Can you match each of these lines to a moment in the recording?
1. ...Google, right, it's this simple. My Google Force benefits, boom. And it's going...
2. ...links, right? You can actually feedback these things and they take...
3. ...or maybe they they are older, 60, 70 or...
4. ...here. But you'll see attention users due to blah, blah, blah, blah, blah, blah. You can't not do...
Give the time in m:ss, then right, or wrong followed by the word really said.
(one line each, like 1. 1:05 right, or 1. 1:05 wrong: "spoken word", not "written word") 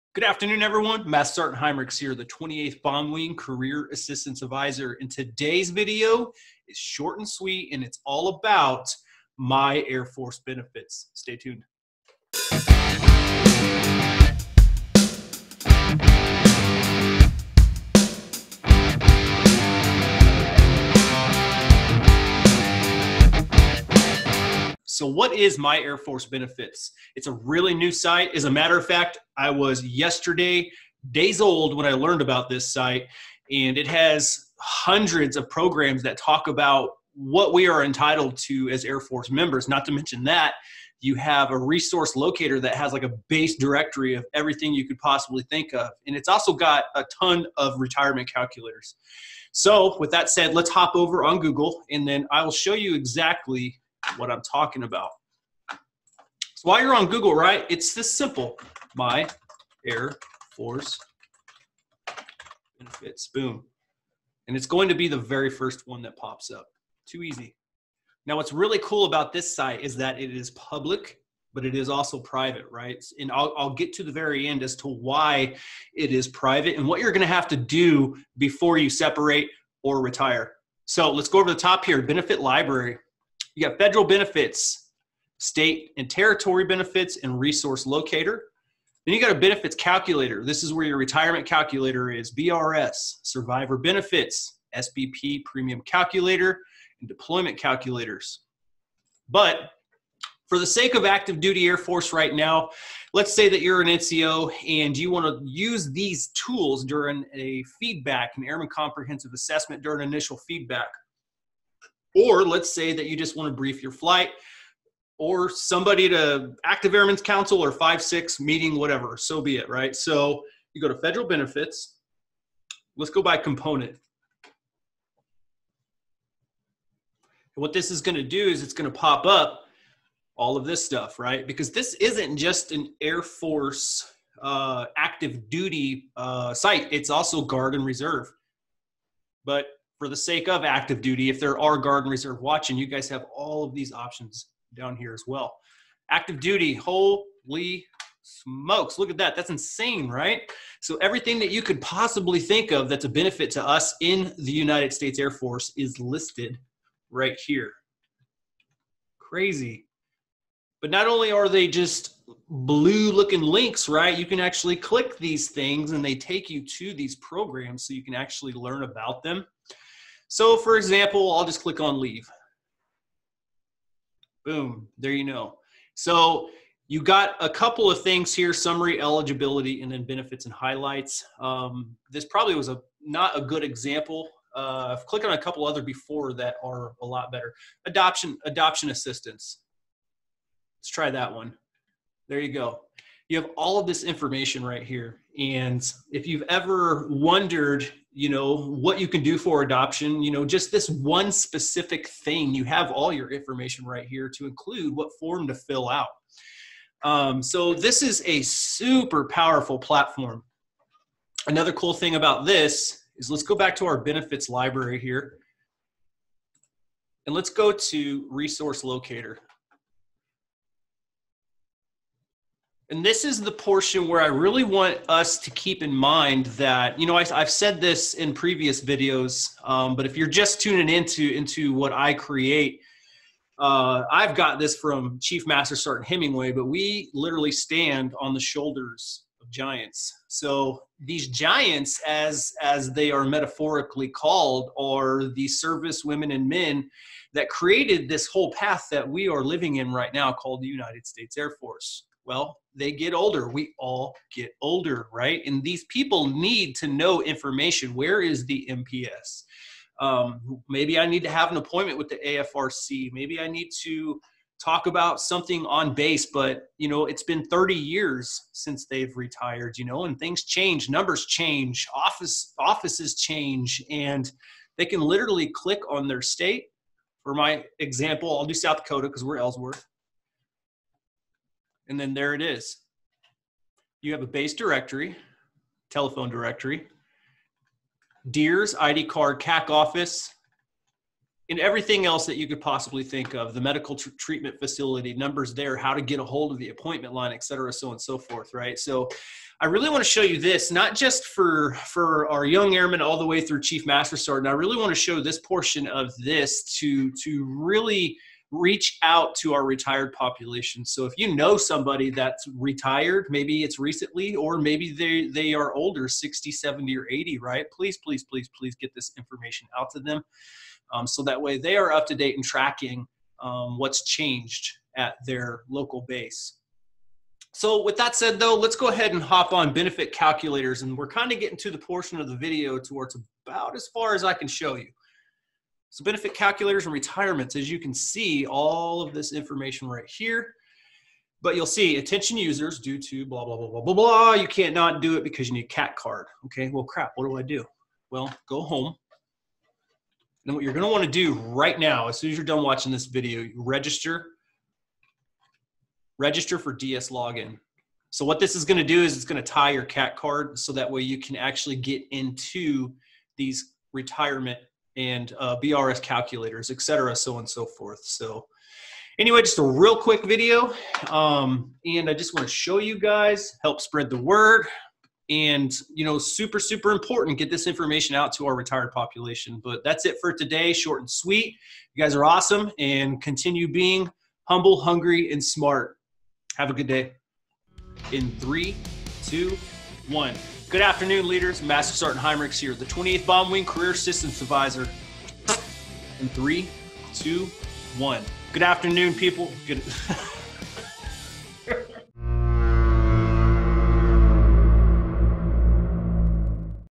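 1. 0:57 wrong: "Air", not "Google"
2. 2:43 wrong: "click", not "feedback"
3. 5:14 right
4. 5:40 right.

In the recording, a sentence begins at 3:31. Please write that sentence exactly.
Another cool thing about this is let's go back to our benefits library here.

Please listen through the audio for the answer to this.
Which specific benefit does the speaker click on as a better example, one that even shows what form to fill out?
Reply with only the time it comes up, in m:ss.
3:08.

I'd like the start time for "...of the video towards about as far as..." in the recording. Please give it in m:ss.
5:32.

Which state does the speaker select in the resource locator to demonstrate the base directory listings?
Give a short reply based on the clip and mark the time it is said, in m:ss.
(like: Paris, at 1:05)
South Dakota, at 4:38.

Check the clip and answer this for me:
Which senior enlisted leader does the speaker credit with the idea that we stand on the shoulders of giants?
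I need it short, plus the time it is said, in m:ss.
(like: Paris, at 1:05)
Chief Master Sergeant Hemingway, at 3:55.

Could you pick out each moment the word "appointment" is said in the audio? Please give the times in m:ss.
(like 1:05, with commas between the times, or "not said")
4:21, 4:56.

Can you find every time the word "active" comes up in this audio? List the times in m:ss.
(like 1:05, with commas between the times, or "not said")
1:41, 1:56, 2:14, 2:20, 2:26.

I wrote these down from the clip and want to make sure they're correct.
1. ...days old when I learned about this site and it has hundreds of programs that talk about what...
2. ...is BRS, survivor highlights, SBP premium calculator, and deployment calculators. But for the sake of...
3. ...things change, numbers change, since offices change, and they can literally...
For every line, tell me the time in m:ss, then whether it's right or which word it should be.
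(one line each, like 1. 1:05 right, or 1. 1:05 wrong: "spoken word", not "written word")
1. 0:31 right
2. 1:32 wrong: "benefits", not "highlights"
3. 4:30 wrong: "office", not "since".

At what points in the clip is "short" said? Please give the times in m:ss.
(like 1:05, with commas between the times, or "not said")
0:06, 6:20.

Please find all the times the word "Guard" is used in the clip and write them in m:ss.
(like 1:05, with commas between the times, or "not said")
2:17, 2:21.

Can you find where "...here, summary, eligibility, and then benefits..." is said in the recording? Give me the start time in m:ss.
2:58.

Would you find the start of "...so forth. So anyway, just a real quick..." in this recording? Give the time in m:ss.
6:07.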